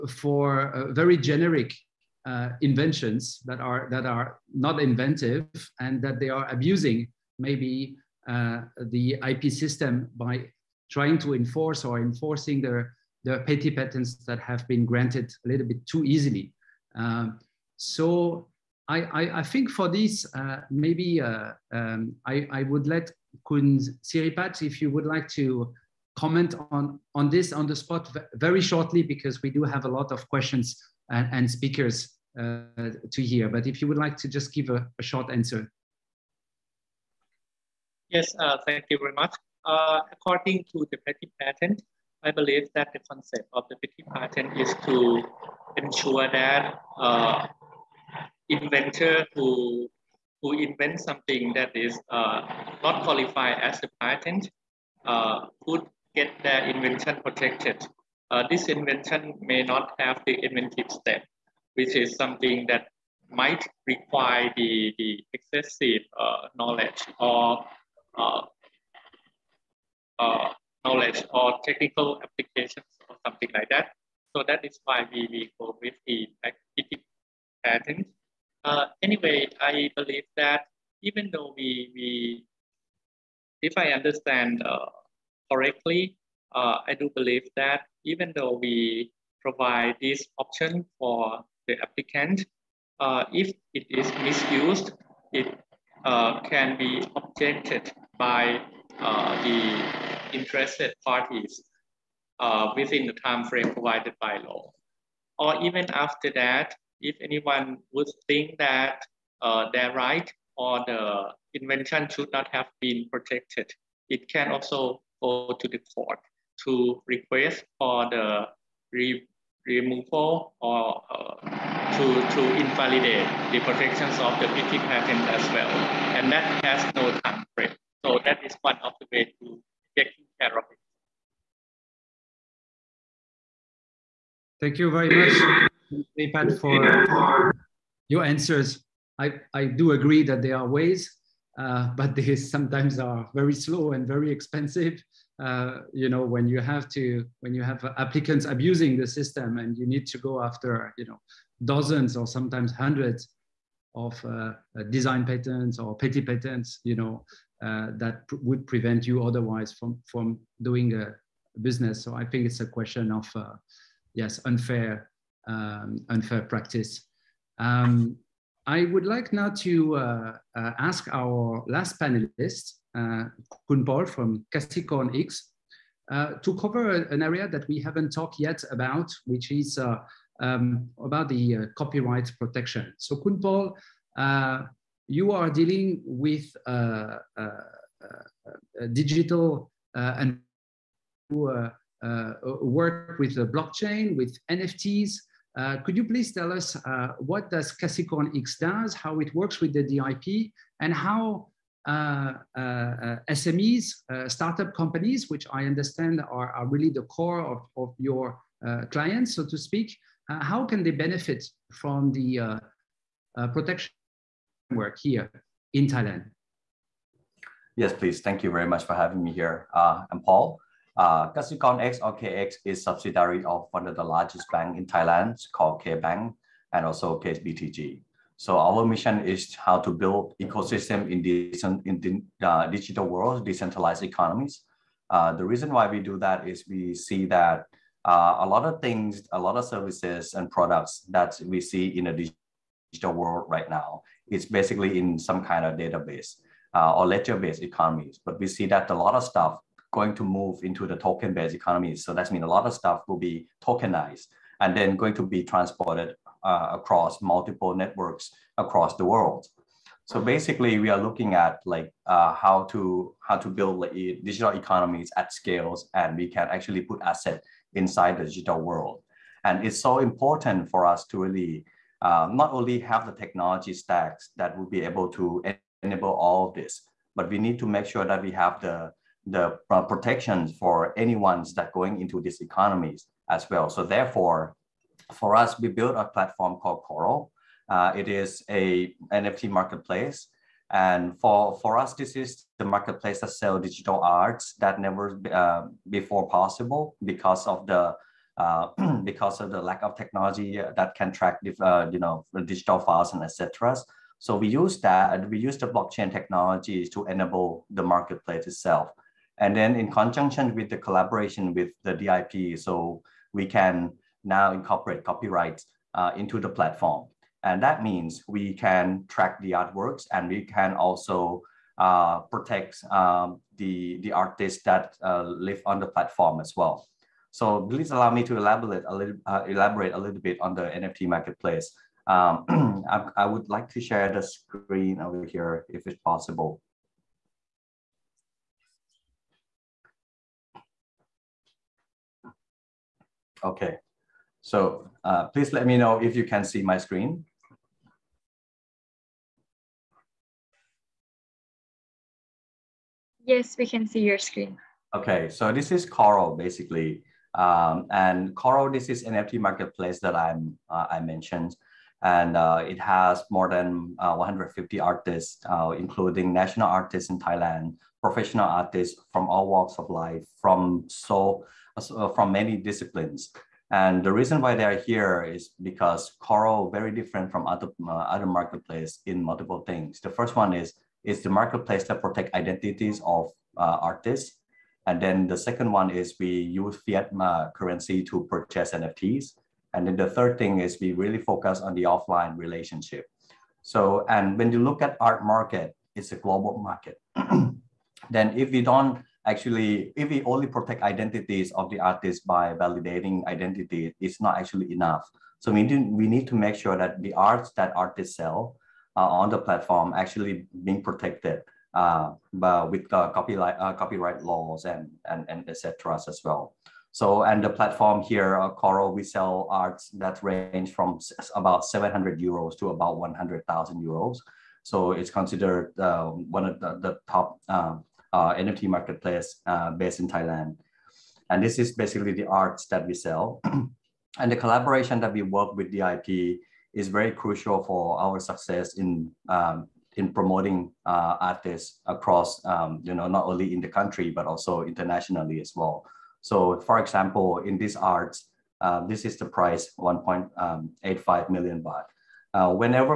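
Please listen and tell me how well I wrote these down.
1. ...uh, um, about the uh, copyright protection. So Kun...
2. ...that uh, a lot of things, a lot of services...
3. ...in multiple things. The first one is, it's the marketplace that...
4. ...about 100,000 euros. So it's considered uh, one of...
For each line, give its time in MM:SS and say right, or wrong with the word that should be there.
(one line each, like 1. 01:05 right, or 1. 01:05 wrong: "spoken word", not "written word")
1. 02:59 right
2. 03:57 right
3. 06:19 right
4. 07:02 right.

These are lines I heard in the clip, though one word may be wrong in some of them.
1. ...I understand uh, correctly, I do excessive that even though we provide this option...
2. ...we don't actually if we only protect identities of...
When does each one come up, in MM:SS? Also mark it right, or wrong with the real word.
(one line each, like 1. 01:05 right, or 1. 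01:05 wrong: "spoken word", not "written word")
1. 01:23 wrong: "believe", not "excessive"
2. 06:38 right.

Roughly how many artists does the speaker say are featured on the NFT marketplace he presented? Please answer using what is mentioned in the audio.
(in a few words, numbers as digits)
150.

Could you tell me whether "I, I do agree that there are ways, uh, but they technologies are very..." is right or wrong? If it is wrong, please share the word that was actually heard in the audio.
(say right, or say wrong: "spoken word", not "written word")
wrong: "sometimes", not "technologies".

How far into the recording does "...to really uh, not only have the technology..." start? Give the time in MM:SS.
04:31.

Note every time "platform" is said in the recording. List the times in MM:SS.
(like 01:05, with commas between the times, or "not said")
04:46, 05:16, 05:25, 06:49, 06:57.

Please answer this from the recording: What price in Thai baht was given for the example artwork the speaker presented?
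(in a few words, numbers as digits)
1.85 million baht.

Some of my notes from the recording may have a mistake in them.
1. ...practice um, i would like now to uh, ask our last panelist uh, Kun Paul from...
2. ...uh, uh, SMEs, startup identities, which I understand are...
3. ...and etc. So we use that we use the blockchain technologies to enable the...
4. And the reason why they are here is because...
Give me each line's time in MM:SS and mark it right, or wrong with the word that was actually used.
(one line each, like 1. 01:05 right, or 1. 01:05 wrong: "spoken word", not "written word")
1. 02:46 right
2. 03:22 wrong: "companies", not "identities"
3. 05:03 right
4. 06:13 right.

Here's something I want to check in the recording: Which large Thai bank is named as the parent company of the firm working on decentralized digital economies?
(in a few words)
K Bank.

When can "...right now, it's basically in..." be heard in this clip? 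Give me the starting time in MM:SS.
04:03.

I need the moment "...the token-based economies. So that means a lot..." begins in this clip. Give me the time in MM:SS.
04:10.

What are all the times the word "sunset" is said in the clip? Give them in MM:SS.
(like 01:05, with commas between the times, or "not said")
not said.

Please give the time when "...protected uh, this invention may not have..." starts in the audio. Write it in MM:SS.
00:57.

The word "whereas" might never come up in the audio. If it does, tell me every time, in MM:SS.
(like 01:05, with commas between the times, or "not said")
not said.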